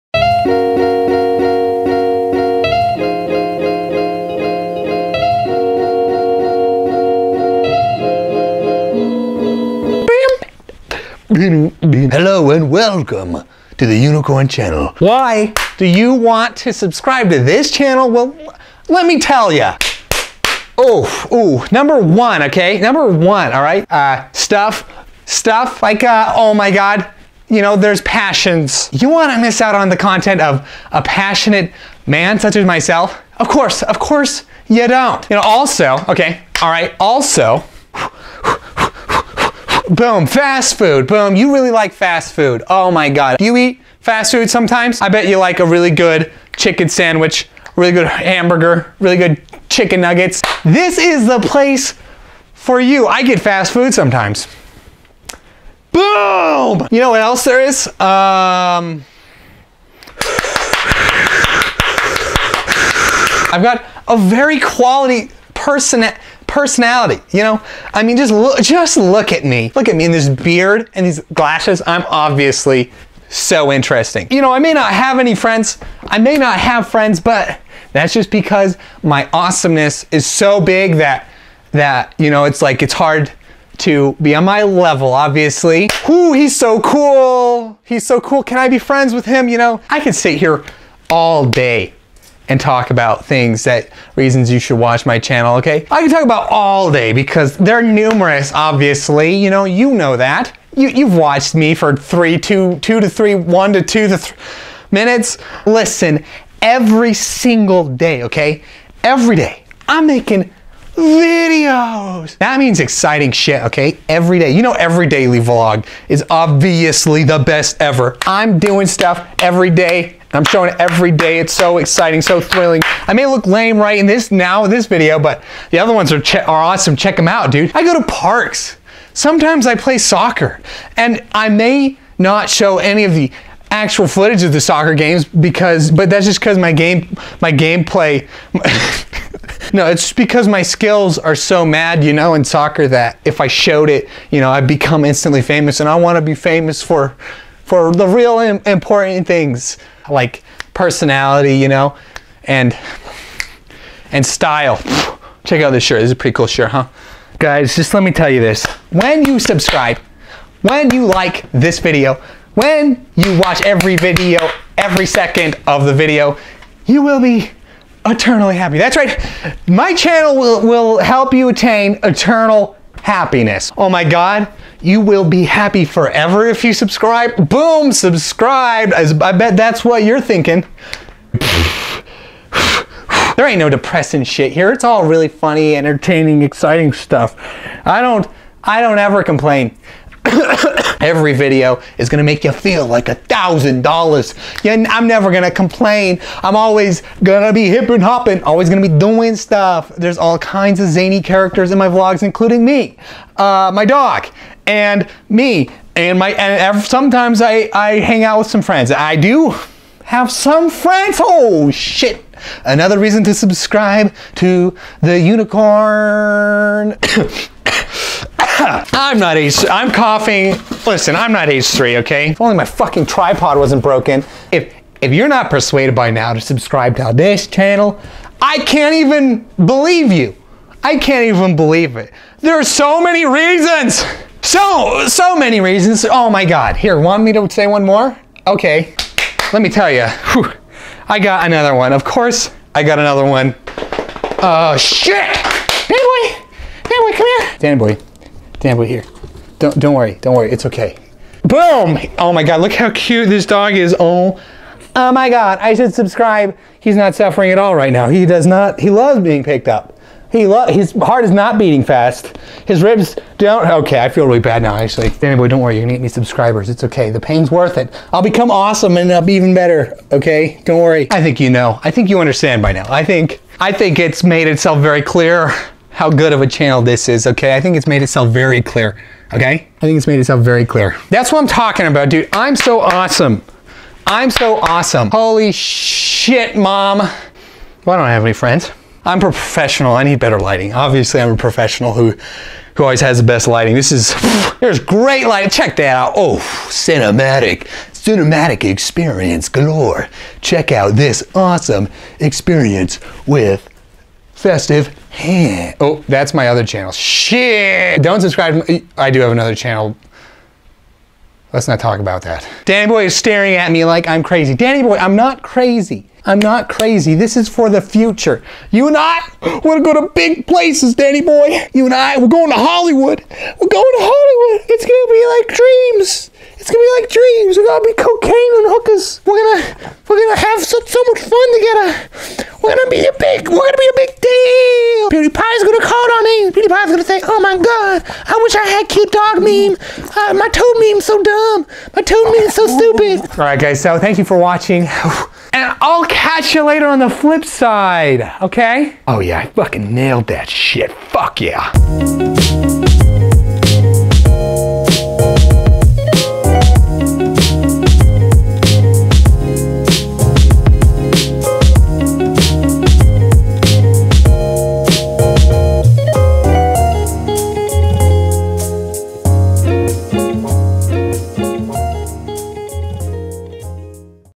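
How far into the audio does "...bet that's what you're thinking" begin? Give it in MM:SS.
02:59.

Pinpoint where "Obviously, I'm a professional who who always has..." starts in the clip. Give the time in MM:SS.
04:50.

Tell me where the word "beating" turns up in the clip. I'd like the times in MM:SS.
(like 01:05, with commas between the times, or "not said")
04:21.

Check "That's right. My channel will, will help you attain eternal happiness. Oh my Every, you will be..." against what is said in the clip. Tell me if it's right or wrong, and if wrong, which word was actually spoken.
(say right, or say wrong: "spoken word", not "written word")
wrong: "God", not "Every".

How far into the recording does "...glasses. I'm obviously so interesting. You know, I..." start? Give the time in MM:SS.
01:11.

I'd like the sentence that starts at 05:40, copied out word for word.
Uh, my toad meme's so dumb.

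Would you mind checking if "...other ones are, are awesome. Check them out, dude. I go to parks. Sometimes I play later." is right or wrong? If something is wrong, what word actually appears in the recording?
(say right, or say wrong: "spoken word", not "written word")
wrong: "soccer", not "later".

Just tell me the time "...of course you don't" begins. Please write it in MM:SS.
00:33.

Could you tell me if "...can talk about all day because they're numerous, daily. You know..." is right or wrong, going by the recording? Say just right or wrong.
wrong.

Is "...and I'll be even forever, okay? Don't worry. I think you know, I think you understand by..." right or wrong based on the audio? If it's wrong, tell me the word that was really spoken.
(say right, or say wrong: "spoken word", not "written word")
wrong: "better", not "forever".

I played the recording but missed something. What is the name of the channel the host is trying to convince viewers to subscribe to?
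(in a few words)
Unicorn Channel.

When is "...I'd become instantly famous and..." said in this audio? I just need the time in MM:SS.
02:24.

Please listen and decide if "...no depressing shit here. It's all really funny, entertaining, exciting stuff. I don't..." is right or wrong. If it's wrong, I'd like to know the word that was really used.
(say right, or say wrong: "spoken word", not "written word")
right.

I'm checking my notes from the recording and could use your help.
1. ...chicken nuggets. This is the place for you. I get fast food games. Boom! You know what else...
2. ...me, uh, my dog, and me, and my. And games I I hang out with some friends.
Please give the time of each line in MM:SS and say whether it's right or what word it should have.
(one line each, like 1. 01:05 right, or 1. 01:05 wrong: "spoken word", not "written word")
1. 00:49 wrong: "sometimes", not "games"
2. 03:22 wrong: "sometimes", not "games".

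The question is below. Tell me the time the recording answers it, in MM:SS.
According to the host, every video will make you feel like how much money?
03:13.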